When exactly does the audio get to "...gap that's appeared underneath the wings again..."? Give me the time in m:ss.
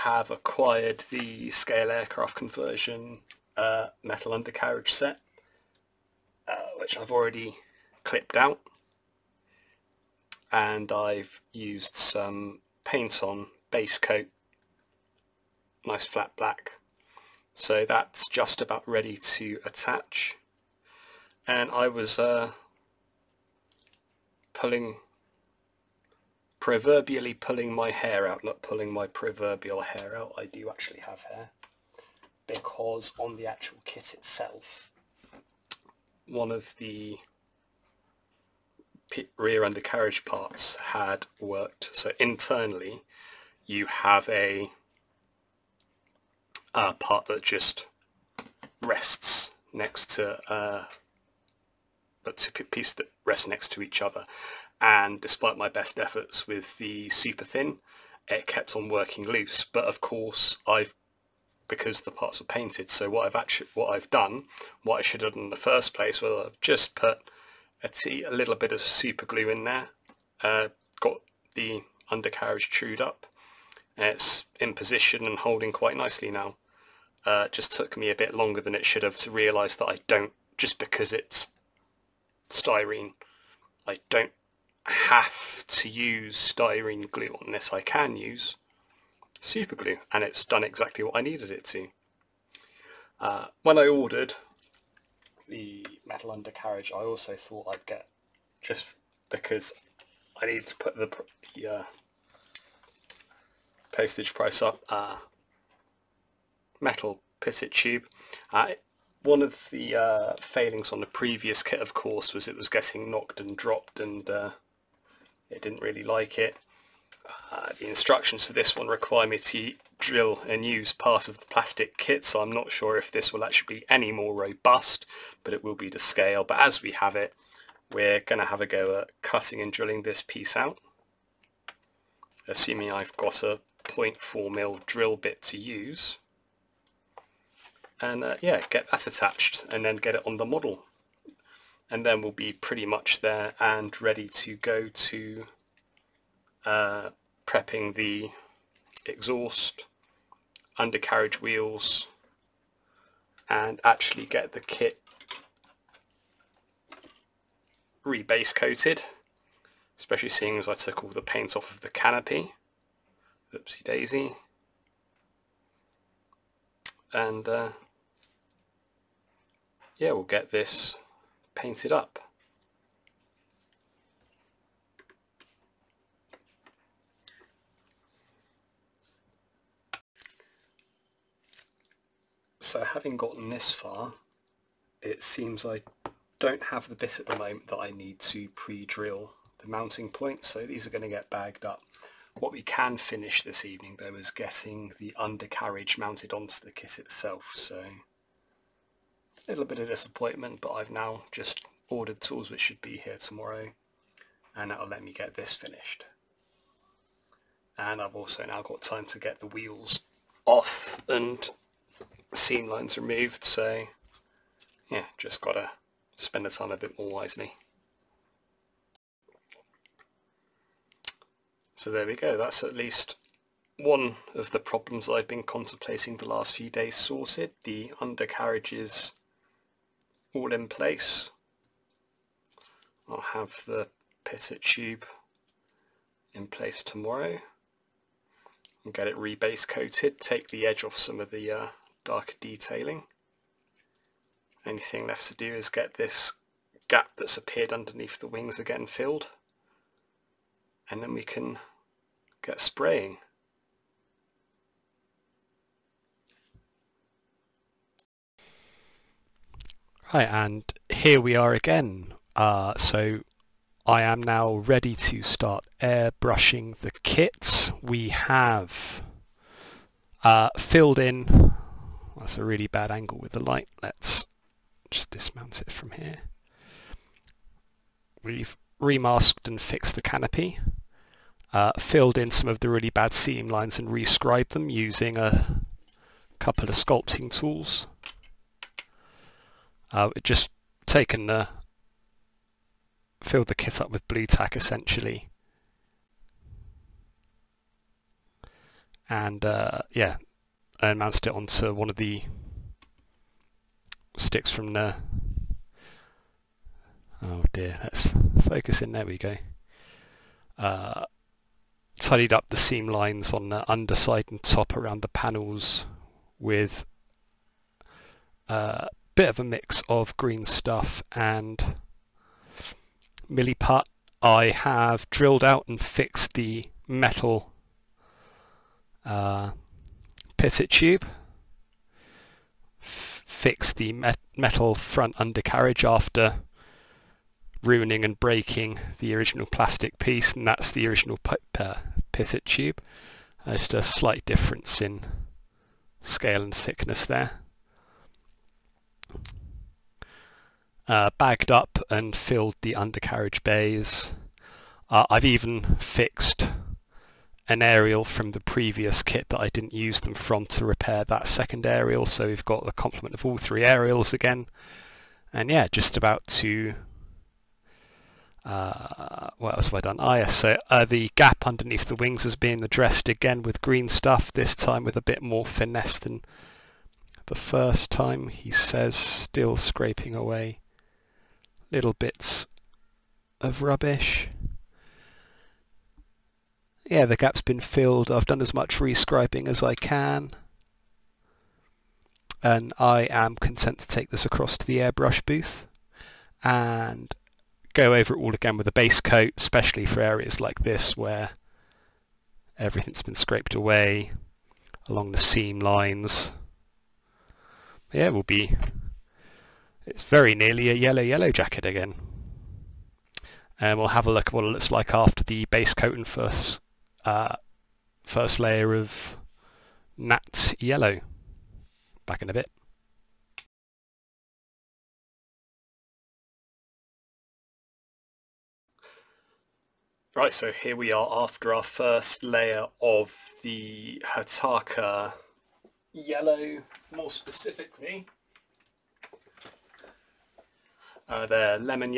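4:06.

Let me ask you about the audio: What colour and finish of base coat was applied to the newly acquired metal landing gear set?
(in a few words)
Flat black.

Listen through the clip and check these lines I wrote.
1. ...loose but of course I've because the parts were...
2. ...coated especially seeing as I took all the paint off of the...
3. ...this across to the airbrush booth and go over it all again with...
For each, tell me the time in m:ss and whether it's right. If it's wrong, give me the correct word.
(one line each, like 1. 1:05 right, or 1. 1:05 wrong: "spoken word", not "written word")
1. 0:59 right
2. 2:38 right
3. 6:34 right.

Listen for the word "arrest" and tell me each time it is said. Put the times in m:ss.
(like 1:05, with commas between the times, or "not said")
not said.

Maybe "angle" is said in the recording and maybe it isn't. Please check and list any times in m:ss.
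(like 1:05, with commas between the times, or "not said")
4:32.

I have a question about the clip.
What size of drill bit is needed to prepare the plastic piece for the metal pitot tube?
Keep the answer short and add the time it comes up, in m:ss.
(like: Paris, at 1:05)
0.4 mil, at 2:13.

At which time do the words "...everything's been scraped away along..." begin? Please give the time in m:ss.
6:42.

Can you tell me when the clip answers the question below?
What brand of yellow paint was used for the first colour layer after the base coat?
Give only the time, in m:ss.
7:14.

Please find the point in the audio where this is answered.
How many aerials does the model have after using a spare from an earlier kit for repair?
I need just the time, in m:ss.
6:03.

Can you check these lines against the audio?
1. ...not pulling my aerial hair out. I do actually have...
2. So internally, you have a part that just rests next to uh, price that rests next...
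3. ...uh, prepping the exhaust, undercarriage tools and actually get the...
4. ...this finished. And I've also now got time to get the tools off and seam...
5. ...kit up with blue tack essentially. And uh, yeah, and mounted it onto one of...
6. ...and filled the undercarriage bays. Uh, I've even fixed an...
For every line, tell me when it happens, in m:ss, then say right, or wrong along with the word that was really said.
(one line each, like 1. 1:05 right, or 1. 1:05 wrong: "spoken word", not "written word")
1. 0:28 wrong: "proverbial", not "aerial"
2. 0:41 wrong: "piece", not "price"
3. 2:26 wrong: "wheels", not "tools"
4. 3:25 wrong: "wheels", not "tools"
5. 4:53 right
6. 5:51 right.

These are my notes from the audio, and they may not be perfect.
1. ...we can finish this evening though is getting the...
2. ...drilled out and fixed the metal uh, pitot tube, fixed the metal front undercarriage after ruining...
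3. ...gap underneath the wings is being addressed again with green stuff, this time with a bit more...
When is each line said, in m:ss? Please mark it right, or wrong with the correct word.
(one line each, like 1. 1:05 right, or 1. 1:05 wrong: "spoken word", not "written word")
1. 3:12 right
2. 5:25 right
3. 6:11 right.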